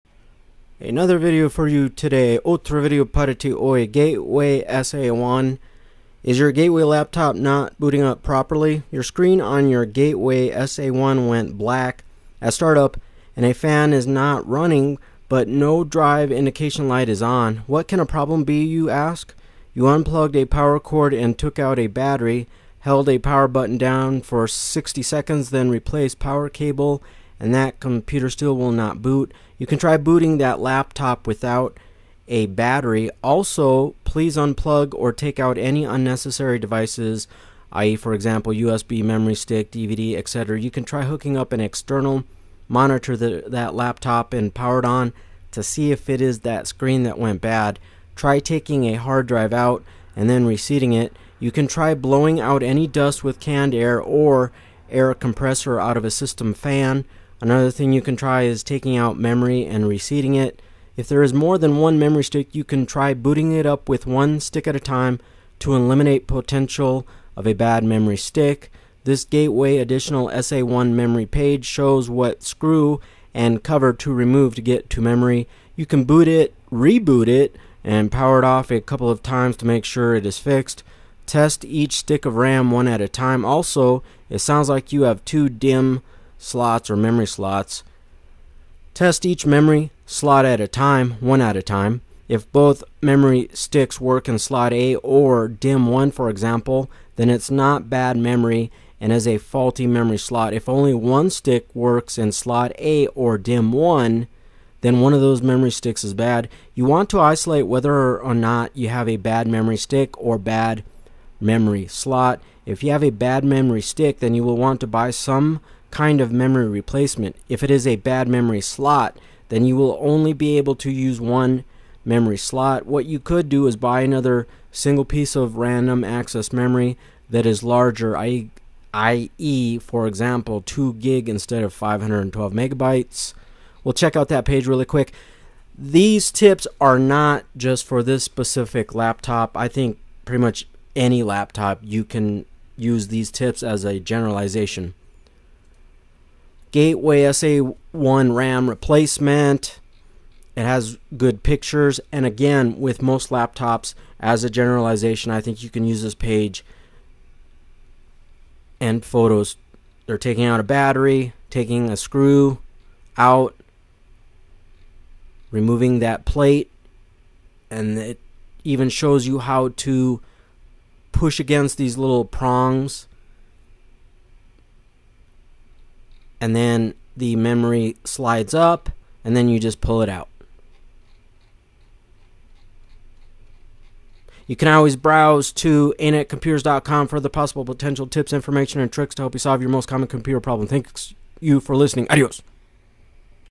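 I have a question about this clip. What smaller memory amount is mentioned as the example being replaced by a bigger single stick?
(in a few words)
512 megabytes.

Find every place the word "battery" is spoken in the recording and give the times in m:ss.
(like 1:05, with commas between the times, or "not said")
0:21, 0:32, 2:40.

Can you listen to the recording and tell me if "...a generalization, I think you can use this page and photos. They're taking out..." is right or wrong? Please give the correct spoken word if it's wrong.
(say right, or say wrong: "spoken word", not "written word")
right.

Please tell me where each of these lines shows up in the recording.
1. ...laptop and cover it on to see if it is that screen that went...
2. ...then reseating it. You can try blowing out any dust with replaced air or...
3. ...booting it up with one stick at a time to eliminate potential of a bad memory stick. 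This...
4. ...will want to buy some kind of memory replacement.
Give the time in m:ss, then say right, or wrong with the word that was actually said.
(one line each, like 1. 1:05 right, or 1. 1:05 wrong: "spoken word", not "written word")
1. 0:43 wrong: "power", not "cover"
2. 0:50 wrong: "canned", not "replaced"
3. 1:03 right
4. 1:54 right.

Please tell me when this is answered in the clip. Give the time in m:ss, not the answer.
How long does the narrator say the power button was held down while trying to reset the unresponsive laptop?
0:24.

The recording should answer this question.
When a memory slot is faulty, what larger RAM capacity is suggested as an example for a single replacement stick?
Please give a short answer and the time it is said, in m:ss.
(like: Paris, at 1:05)
2 gig, at 2:10.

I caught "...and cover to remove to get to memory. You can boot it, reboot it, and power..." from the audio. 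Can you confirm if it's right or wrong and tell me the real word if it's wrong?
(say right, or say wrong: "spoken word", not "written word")
right.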